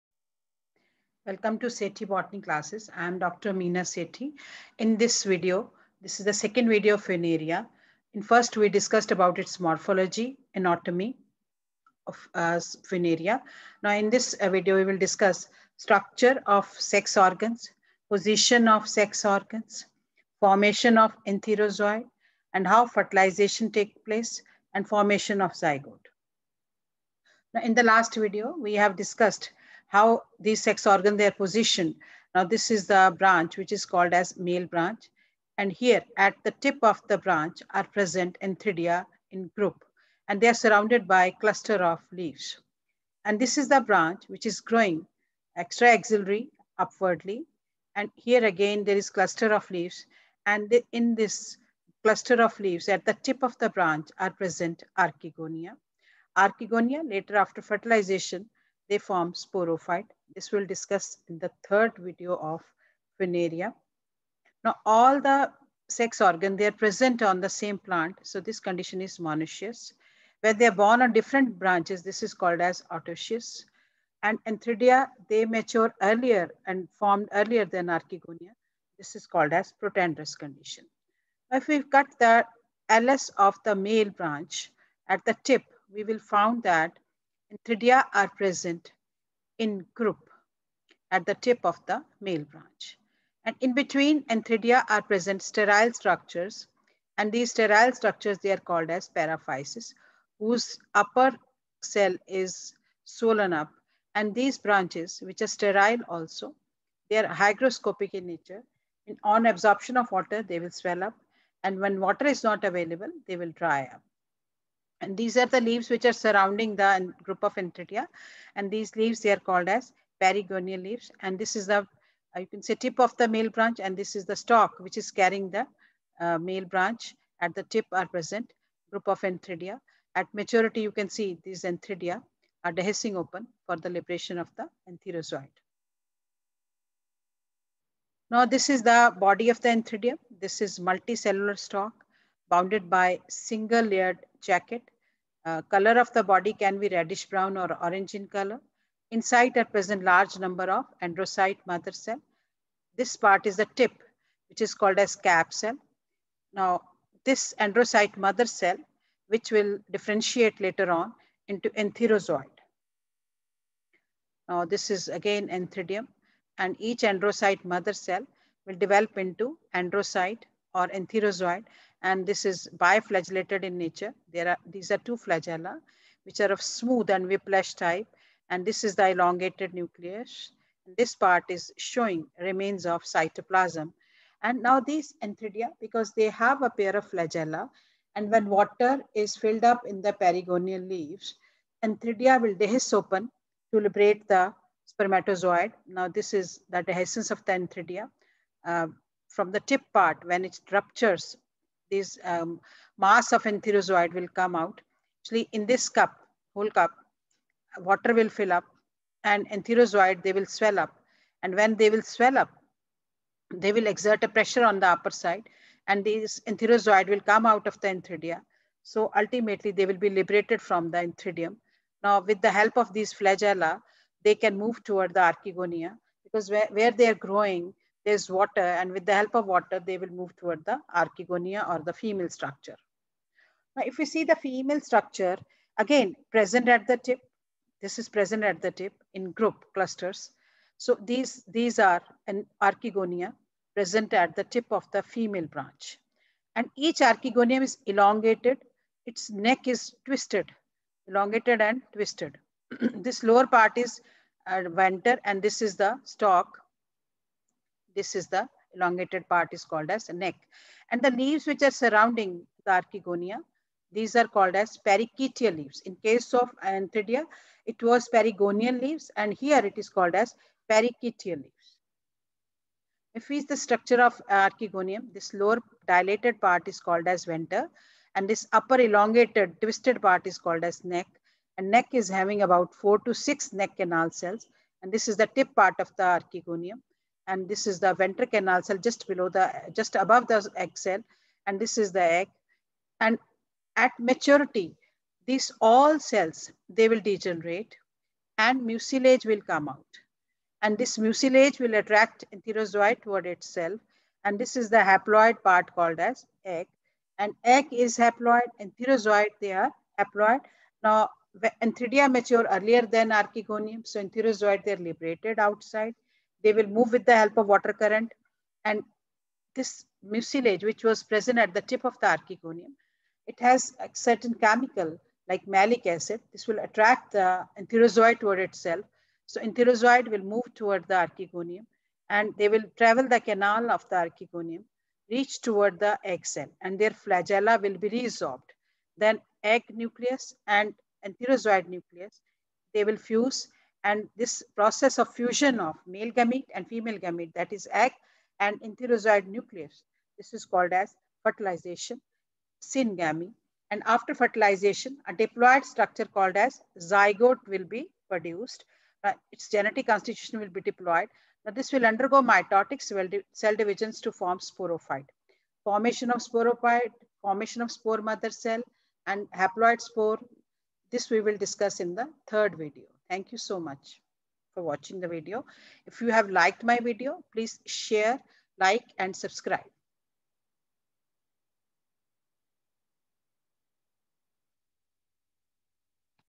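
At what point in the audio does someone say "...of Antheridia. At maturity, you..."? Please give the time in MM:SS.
02:09.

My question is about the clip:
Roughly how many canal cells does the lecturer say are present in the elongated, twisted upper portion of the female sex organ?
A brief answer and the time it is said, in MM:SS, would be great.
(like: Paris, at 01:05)
4 to 6, at 04:42.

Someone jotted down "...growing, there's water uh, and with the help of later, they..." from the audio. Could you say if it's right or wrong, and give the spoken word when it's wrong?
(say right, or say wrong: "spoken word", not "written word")
wrong: "water", not "later".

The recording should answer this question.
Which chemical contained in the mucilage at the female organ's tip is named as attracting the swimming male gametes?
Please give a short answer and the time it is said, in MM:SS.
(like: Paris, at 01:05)
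malic acid, at 05:25.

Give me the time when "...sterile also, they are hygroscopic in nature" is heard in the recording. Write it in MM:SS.
01:45.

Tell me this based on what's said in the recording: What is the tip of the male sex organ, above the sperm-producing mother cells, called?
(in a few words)
cap cell.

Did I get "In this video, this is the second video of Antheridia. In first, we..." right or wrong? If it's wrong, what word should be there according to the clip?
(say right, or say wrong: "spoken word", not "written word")
wrong: "Funaria", not "Antheridia".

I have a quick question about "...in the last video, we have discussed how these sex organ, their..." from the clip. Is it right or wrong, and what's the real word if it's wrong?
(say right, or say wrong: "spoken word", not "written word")
right.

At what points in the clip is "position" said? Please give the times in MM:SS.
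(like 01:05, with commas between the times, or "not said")
00:18, 00:31.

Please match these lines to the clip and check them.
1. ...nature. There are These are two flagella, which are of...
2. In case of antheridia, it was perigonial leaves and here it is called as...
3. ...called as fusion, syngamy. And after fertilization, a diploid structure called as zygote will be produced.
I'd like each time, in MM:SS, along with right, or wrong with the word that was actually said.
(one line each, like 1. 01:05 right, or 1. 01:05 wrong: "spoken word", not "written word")
1. 02:53 right
2. 04:25 right
3. 05:50 wrong: "fertilization", not "fusion".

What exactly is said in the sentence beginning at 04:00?
So these, these are an archegonia present at the tip of the female branch.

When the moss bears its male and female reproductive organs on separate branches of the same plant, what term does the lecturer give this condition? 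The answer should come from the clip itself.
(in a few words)
autoecious.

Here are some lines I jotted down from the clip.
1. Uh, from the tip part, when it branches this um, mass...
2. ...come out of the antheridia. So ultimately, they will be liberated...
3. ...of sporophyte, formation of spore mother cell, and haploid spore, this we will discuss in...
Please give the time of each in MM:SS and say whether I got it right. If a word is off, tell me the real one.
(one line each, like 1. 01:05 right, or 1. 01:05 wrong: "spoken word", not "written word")
1. 03:18 wrong: "ruptures", not "branches"
2. 03:37 right
3. 06:06 right.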